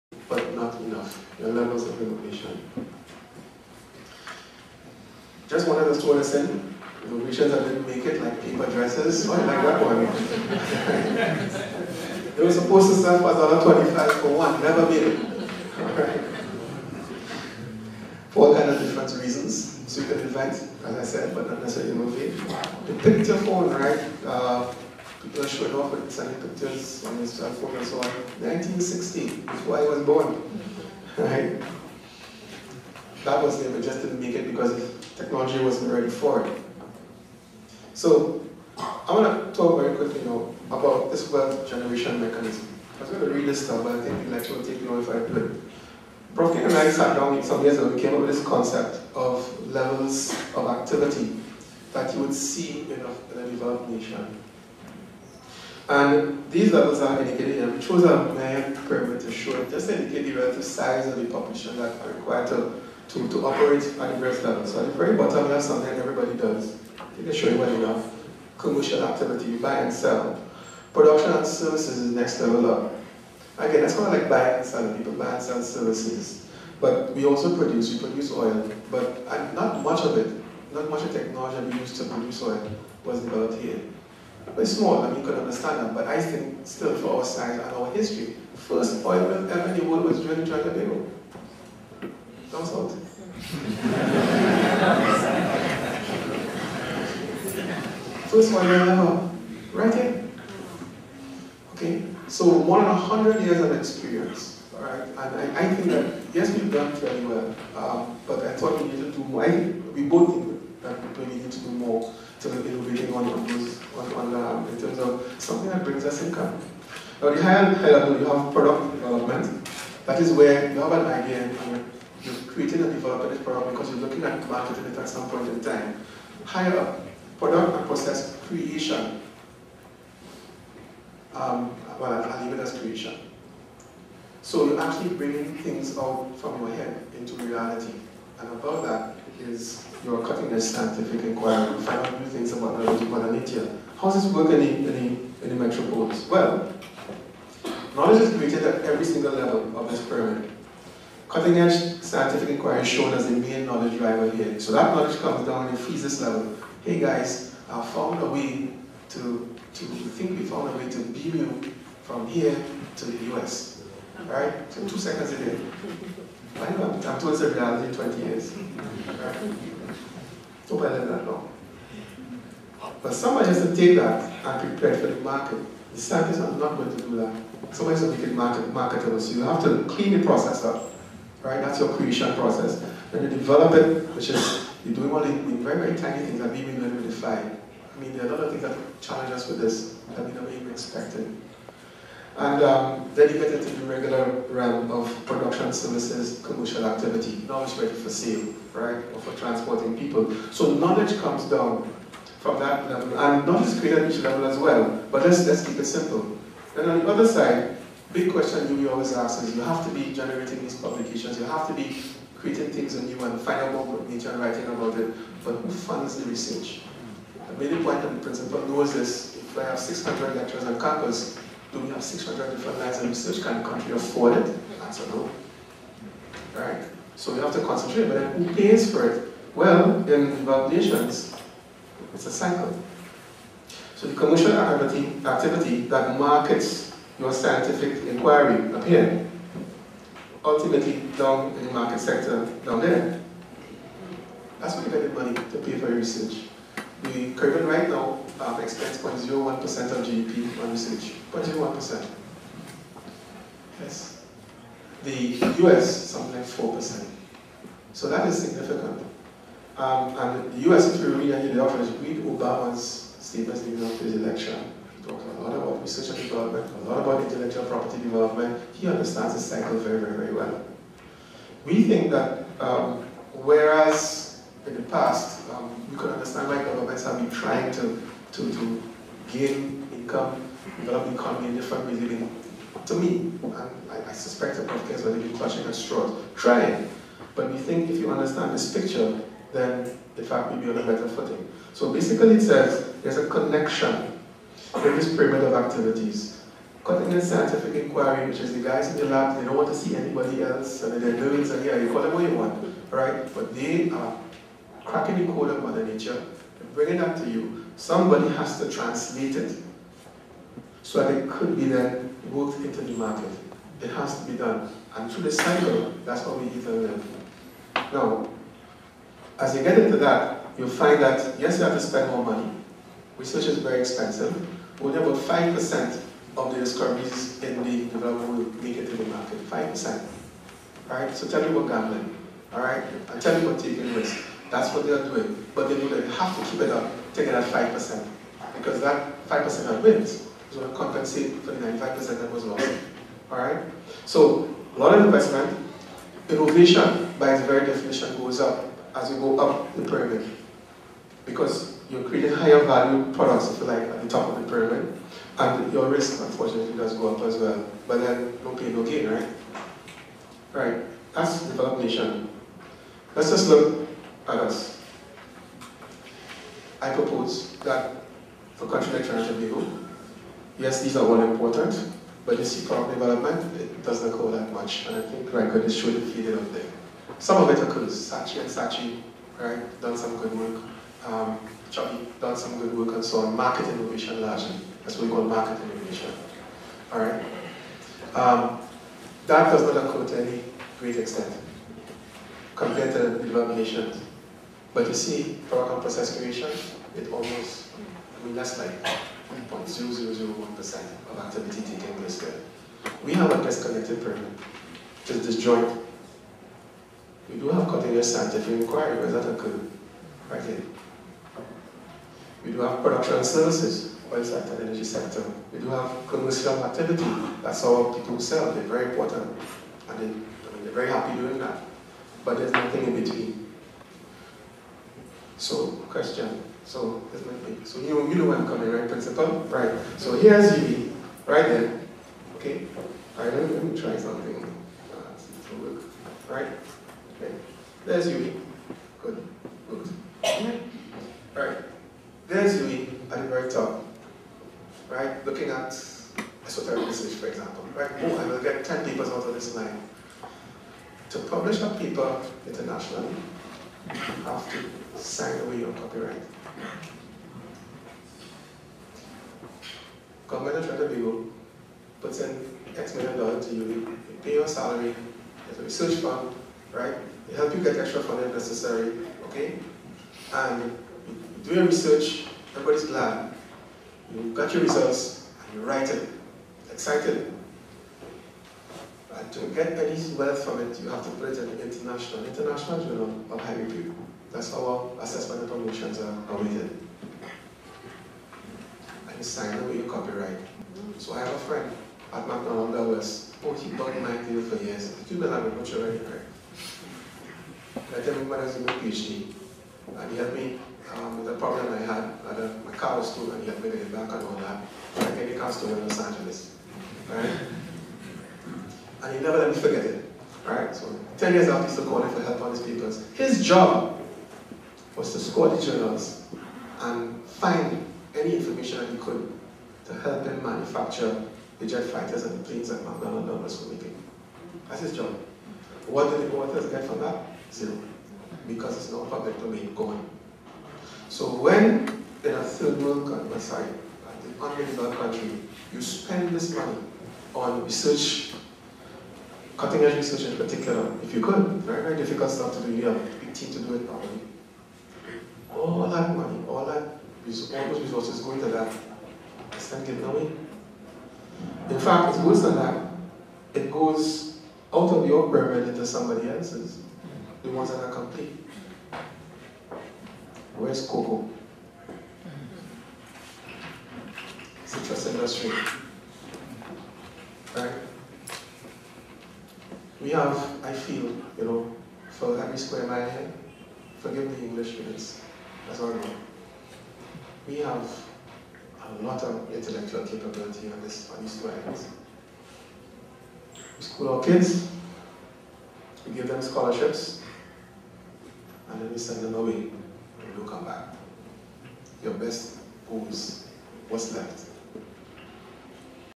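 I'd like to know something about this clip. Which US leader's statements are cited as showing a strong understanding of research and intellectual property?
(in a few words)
Obama.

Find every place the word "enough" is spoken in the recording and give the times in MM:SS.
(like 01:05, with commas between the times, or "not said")
00:00, 01:07.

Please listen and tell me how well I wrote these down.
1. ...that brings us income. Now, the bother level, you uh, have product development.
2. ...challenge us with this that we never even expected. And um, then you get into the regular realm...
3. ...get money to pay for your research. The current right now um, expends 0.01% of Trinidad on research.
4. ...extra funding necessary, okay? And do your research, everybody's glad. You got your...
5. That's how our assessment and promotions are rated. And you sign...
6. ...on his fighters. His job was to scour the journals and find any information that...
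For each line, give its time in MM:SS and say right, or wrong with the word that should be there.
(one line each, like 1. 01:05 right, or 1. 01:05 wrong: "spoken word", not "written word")
1. 01:55 wrong: "higher", not "bother"
2. 03:09 right
3. 04:04 wrong: "GDP", not "Trinidad"
4. 07:47 right
5. 08:04 right
6. 08:32 wrong: "papers", not "fighters".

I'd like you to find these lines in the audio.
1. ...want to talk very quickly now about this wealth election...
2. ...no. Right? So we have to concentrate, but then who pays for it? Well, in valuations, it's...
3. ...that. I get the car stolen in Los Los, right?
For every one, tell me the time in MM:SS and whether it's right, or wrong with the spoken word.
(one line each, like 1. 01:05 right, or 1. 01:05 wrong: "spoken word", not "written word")
1. 00:39 wrong: "generation", not "election"
2. 03:45 right
3. 08:24 wrong: "Angeles", not "Los".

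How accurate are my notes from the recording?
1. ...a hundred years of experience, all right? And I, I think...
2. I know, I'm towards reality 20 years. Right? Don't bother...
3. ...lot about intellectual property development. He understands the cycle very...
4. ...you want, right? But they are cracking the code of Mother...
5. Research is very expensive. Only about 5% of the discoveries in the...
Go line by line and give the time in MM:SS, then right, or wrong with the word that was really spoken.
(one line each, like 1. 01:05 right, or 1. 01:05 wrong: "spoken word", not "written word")
1. 01:42 right
2. 02:46 right
3. 04:26 right
4. 05:02 right
5. 05:23 right.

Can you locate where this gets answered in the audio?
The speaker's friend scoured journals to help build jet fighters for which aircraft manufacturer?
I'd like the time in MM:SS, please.
08:42.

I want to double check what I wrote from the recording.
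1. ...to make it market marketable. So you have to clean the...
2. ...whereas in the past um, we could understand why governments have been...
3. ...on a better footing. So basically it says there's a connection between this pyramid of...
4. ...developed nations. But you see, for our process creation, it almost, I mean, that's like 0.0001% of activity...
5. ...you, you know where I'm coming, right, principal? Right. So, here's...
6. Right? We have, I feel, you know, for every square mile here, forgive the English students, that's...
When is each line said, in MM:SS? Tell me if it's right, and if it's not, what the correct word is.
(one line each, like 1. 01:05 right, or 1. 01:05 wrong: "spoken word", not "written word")
1. 02:58 right
2. 04:33 right
3. 04:50 right
4. 06:33 right
5. 07:07 right
6. 09:27 right.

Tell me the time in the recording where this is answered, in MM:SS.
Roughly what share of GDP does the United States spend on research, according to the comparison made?
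04:16.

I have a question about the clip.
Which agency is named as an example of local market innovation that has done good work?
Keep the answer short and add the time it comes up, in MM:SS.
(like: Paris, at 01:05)
Saatchi and Saatchi, at 06:18.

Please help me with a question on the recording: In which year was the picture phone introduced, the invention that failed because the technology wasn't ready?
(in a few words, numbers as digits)
1960.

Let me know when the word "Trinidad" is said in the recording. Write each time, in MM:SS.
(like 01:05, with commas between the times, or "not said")
01:30, 06:09, 07:40.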